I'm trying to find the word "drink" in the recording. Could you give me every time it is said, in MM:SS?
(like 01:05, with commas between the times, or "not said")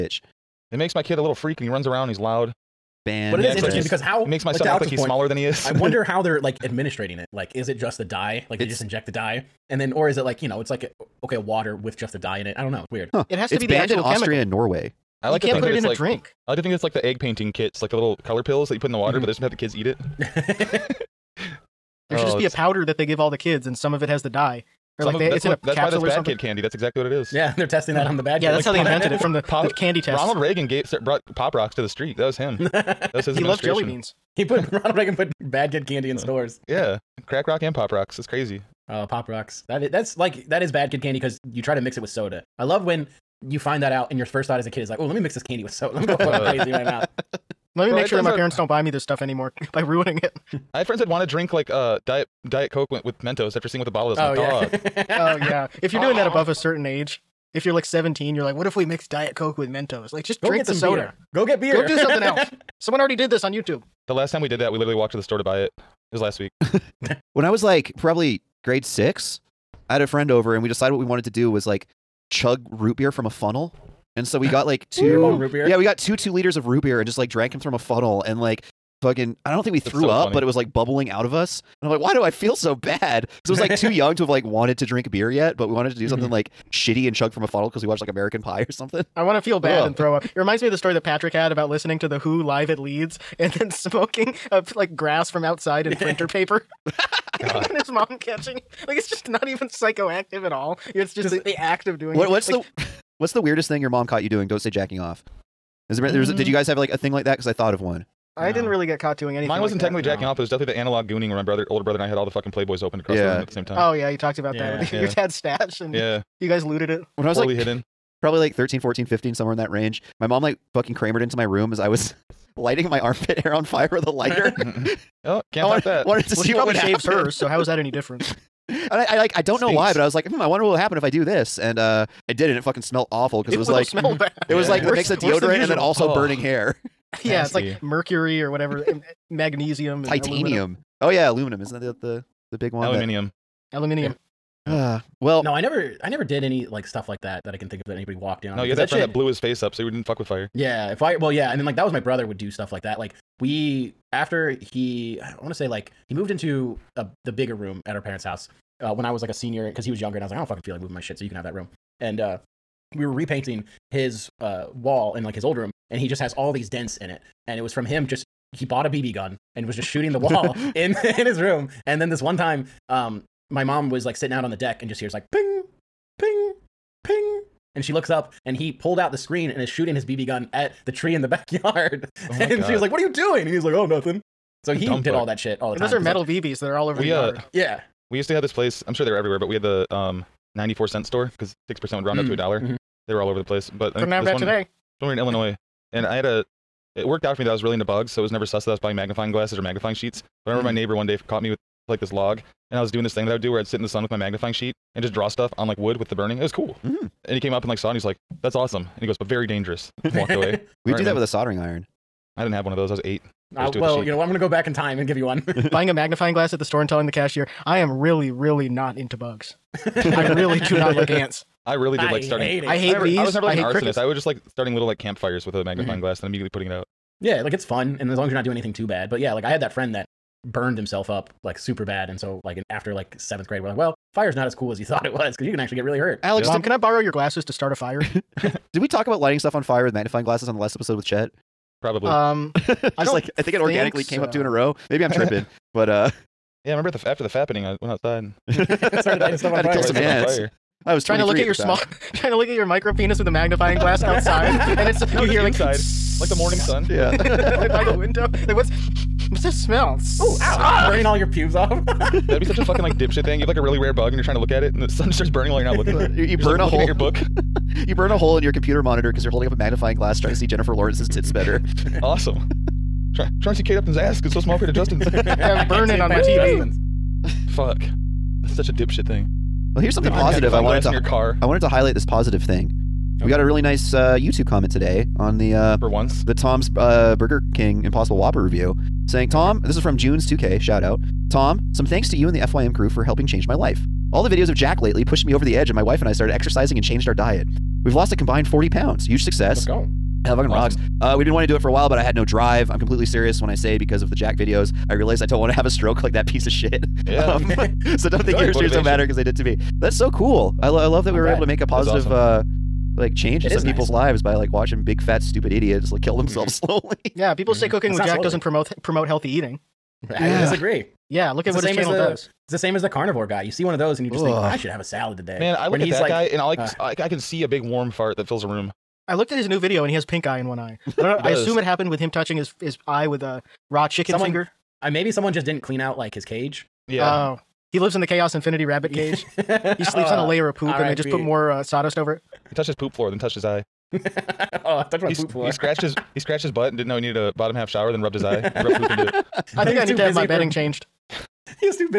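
00:15, 00:51, 01:00, 01:24.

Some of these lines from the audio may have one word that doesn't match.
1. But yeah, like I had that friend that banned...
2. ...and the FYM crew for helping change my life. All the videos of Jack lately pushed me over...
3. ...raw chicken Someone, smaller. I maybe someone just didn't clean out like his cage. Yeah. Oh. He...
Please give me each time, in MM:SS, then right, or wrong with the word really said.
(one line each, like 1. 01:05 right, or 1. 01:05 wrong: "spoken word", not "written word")
1. 03:49 wrong: "burned", not "banned"
2. 04:52 right
3. 05:33 wrong: "finger", not "smaller".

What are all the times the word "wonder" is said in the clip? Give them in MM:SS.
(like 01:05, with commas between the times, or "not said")
00:05, 02:10.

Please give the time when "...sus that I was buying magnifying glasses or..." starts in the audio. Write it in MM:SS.
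03:18.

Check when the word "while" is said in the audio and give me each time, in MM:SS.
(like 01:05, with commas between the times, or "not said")
04:25, 05:01.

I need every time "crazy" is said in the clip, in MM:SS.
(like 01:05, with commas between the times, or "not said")
00:38, 00:46.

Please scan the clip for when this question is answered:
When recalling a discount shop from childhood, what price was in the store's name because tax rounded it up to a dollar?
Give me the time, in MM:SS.
03:10.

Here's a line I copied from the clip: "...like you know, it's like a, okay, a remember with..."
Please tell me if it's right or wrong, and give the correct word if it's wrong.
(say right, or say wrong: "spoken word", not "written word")
wrong: "water", not "remember".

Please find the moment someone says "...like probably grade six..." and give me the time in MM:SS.
01:07.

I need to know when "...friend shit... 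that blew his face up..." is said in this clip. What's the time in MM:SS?
02:28.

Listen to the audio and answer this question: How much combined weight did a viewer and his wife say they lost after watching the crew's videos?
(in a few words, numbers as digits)
40 pounds.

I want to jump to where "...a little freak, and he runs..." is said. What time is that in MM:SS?
00:01.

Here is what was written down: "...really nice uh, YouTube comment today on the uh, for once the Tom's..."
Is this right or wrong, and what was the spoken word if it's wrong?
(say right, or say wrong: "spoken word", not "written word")
right.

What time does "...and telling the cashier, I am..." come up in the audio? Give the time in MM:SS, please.
03:36.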